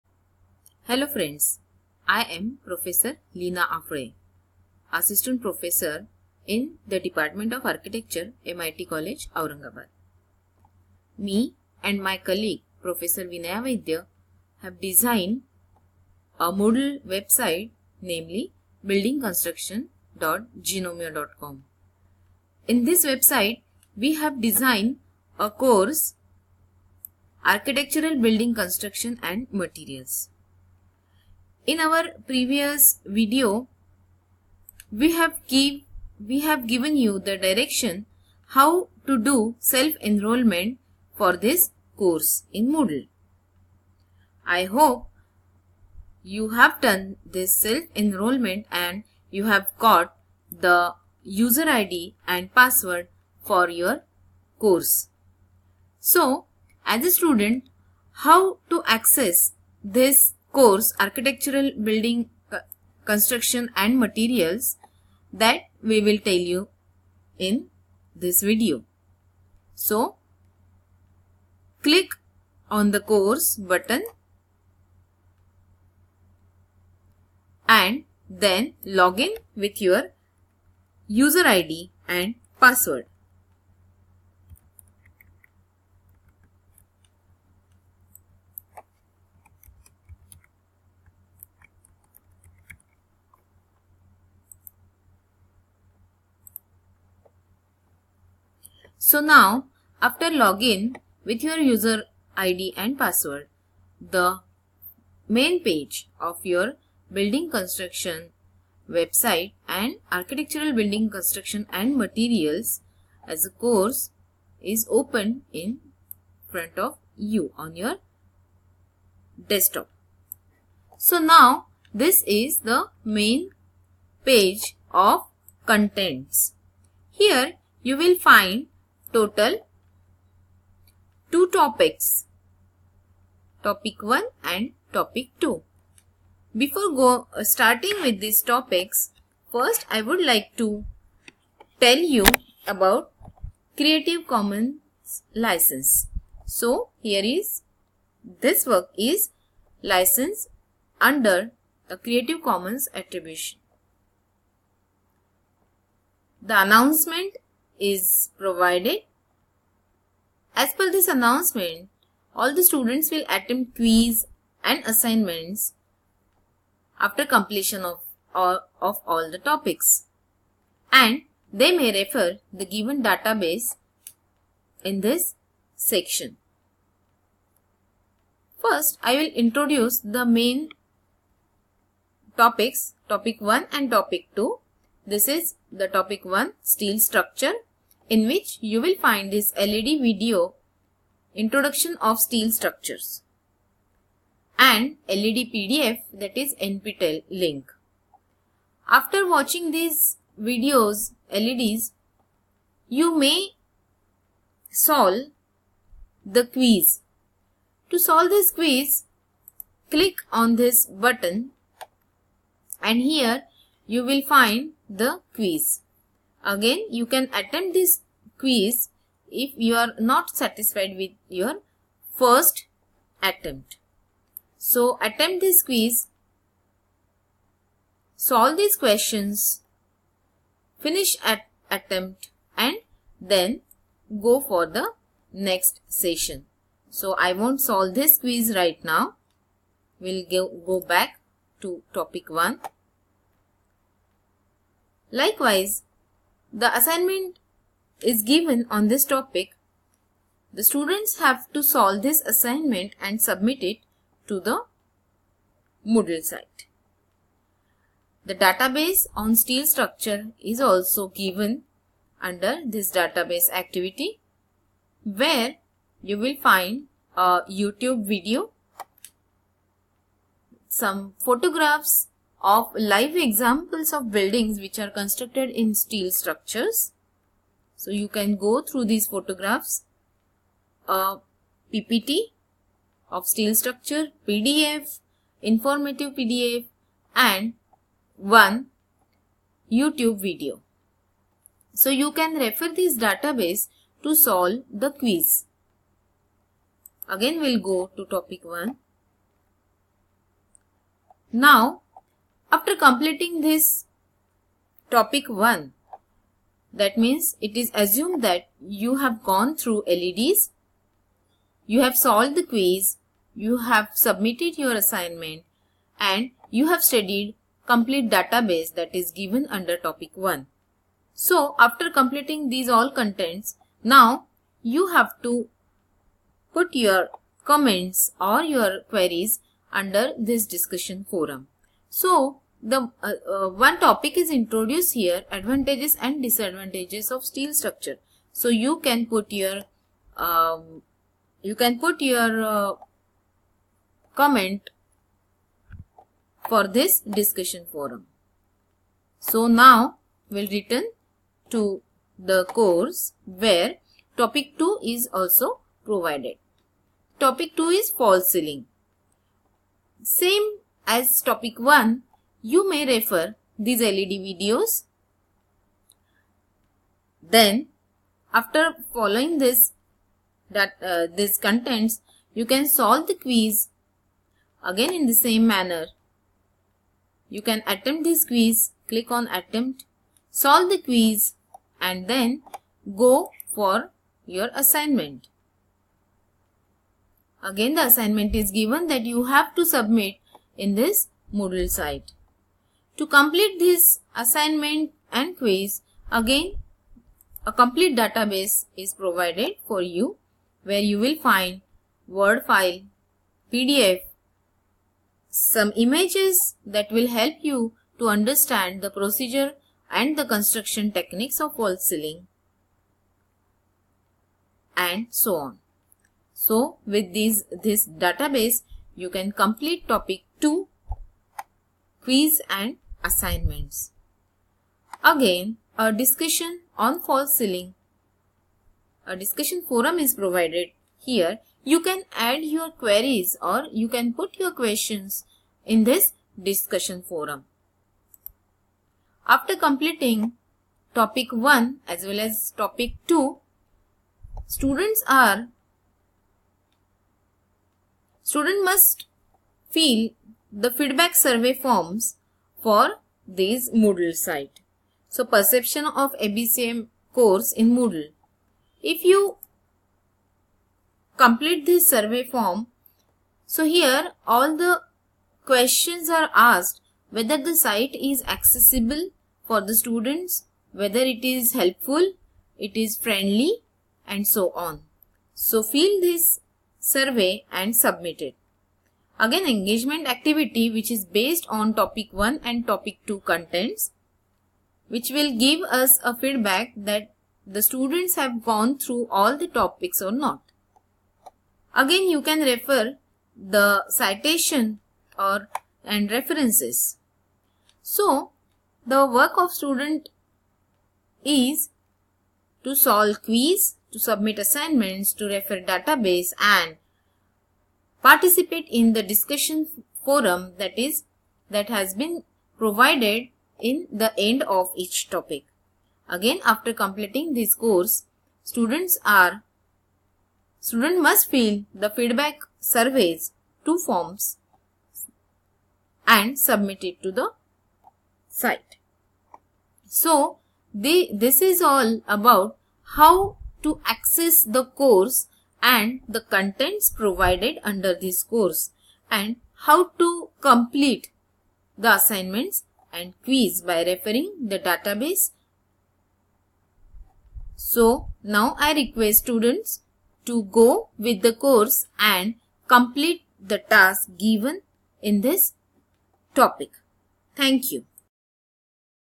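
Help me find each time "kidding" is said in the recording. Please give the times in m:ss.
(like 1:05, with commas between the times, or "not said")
not said.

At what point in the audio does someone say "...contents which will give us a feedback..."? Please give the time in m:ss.
8:03.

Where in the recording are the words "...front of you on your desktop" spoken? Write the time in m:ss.
1:56.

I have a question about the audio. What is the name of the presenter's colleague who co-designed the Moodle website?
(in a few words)
Vinaya Vaidya.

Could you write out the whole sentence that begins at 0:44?
I hope you have done this self enrollment and you have got the user ID and password for your course.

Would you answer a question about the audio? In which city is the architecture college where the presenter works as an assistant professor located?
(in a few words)
Aurangabad.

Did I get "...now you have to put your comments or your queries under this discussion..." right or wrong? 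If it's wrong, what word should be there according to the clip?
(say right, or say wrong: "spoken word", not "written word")
right.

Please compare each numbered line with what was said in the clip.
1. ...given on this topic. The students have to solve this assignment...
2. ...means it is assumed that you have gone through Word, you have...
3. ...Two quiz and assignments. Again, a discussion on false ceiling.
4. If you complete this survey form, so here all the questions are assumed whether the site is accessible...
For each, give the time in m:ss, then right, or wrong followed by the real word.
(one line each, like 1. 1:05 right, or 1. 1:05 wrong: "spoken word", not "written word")
1. 4:08 right
2. 5:06 wrong: "LEDs", not "Word"
3. 7:00 right
4. 7:38 wrong: "asked", not "assumed".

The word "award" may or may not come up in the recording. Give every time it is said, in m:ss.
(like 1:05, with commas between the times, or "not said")
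not said.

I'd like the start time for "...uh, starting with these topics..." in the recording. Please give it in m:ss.
2:17.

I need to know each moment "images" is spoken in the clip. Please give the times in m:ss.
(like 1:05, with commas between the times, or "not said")
6:45.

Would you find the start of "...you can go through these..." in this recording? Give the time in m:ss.
4:37.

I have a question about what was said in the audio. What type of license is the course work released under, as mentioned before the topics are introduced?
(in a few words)
Creative Commons attribution.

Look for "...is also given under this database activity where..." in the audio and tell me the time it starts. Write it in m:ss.
4:20.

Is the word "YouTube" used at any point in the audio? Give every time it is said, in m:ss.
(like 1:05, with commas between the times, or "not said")
4:27, 4:49.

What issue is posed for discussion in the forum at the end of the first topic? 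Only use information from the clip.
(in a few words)
Advantages and disadvantages of steel structure.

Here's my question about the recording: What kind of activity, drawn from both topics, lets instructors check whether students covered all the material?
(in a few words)
Engagement activity.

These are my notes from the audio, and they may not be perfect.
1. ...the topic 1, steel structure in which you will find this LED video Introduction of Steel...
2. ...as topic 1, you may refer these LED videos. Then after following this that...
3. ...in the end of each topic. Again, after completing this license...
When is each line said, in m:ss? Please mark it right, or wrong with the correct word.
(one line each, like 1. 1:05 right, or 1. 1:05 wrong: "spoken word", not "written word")
1. 3:05 right
2. 6:00 right
3. 8:33 wrong: "course", not "license".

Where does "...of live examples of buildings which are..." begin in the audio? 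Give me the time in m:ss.
4:32.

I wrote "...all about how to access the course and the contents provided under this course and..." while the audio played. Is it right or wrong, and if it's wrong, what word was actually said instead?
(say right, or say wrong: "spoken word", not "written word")
right.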